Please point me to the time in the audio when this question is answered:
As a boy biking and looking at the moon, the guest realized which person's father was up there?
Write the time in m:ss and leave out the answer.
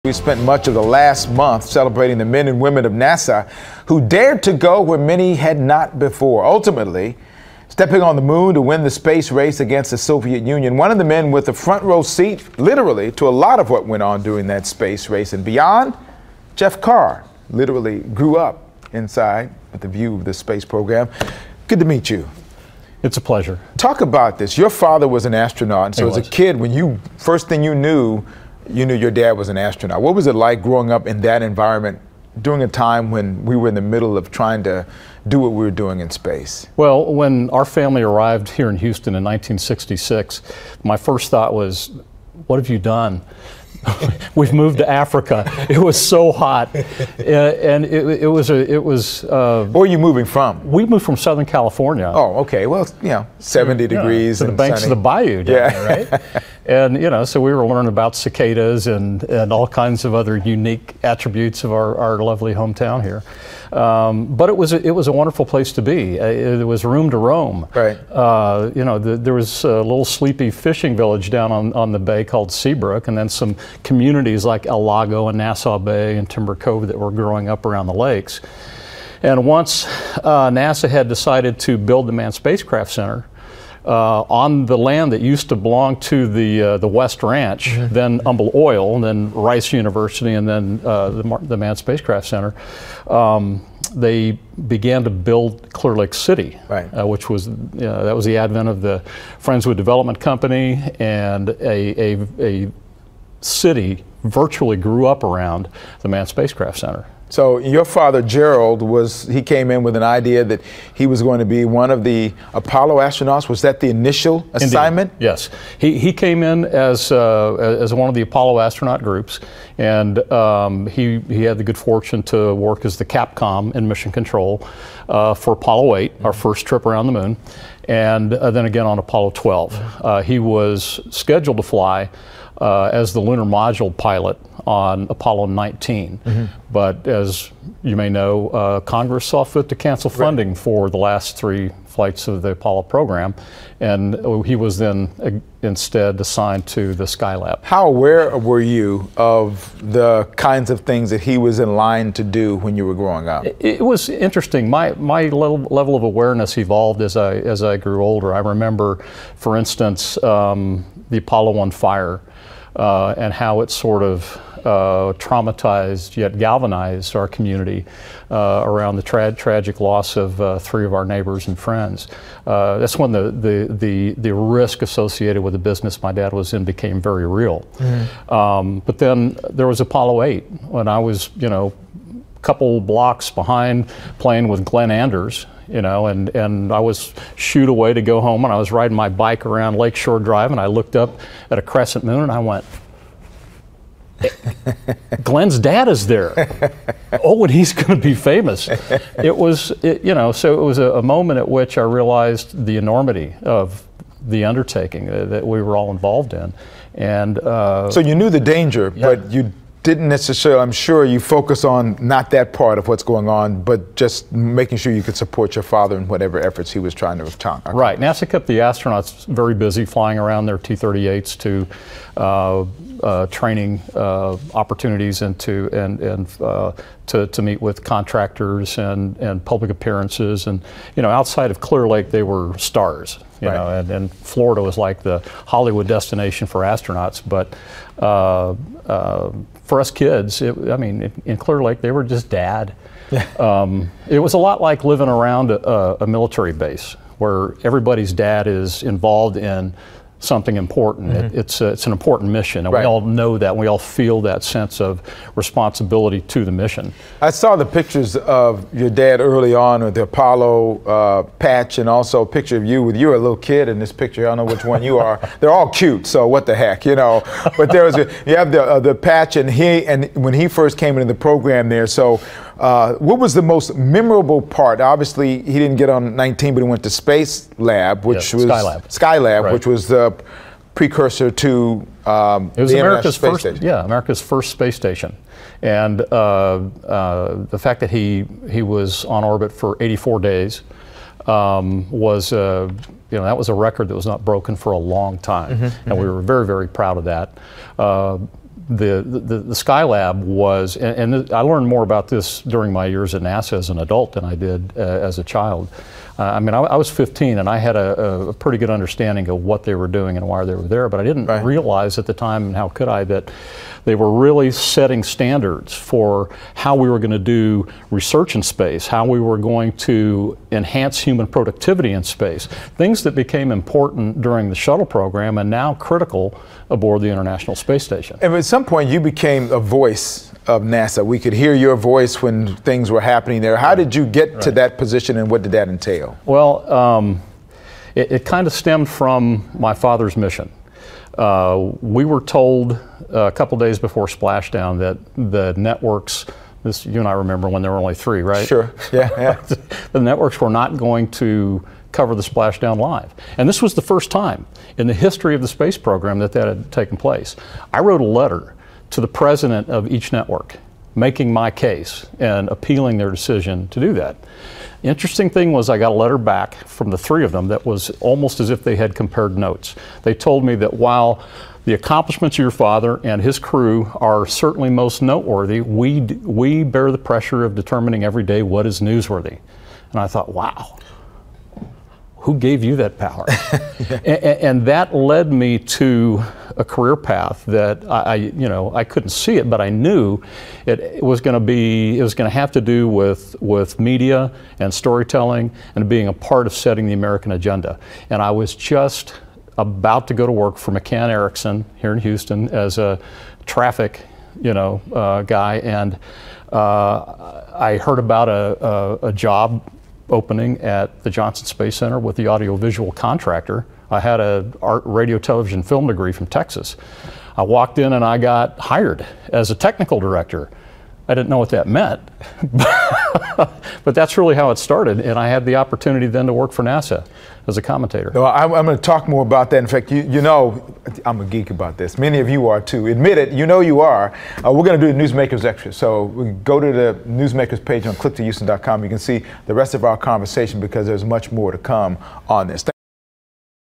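3:04.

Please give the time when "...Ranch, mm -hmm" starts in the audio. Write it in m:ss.
1:27.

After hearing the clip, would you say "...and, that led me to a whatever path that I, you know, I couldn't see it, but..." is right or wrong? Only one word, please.
wrong.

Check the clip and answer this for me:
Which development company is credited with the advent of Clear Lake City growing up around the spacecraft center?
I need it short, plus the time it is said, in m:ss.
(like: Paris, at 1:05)
Friendswood Development Company, at 1:39.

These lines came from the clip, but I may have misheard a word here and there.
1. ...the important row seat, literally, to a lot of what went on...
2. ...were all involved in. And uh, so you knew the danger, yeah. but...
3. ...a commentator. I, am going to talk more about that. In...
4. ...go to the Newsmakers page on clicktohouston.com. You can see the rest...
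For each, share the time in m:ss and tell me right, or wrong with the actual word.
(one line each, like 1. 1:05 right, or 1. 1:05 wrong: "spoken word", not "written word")
1. 0:11 wrong: "front", not "important"
2. 3:25 right
3. 7:07 right
4. 7:16 right.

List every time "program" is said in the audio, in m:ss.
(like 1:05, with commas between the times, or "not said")
0:20, 2:22, 4:31, 5:24, 5:55.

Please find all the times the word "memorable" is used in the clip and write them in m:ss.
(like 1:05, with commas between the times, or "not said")
4:33.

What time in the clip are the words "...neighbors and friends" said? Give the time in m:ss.
2:51.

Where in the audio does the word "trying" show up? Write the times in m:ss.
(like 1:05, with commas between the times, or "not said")
0:34, 3:36.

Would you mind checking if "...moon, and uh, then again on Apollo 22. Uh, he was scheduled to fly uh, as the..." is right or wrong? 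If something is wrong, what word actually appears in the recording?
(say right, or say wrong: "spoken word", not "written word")
wrong: "12", not "22".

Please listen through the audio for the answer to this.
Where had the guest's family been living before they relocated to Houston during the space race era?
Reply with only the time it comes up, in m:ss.
0:51.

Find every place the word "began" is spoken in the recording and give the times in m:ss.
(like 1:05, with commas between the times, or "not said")
1:34.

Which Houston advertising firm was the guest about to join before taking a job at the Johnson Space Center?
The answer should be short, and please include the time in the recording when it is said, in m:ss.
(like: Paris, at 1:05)
McCann Erickson, at 6:40.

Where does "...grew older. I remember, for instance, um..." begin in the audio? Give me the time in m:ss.
2:37.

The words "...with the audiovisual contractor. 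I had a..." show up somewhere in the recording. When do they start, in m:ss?
6:51.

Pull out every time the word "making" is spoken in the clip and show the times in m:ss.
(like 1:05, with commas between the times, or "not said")
3:34, 6:00.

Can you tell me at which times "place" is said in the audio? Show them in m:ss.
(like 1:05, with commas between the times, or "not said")
1:05, 5:56.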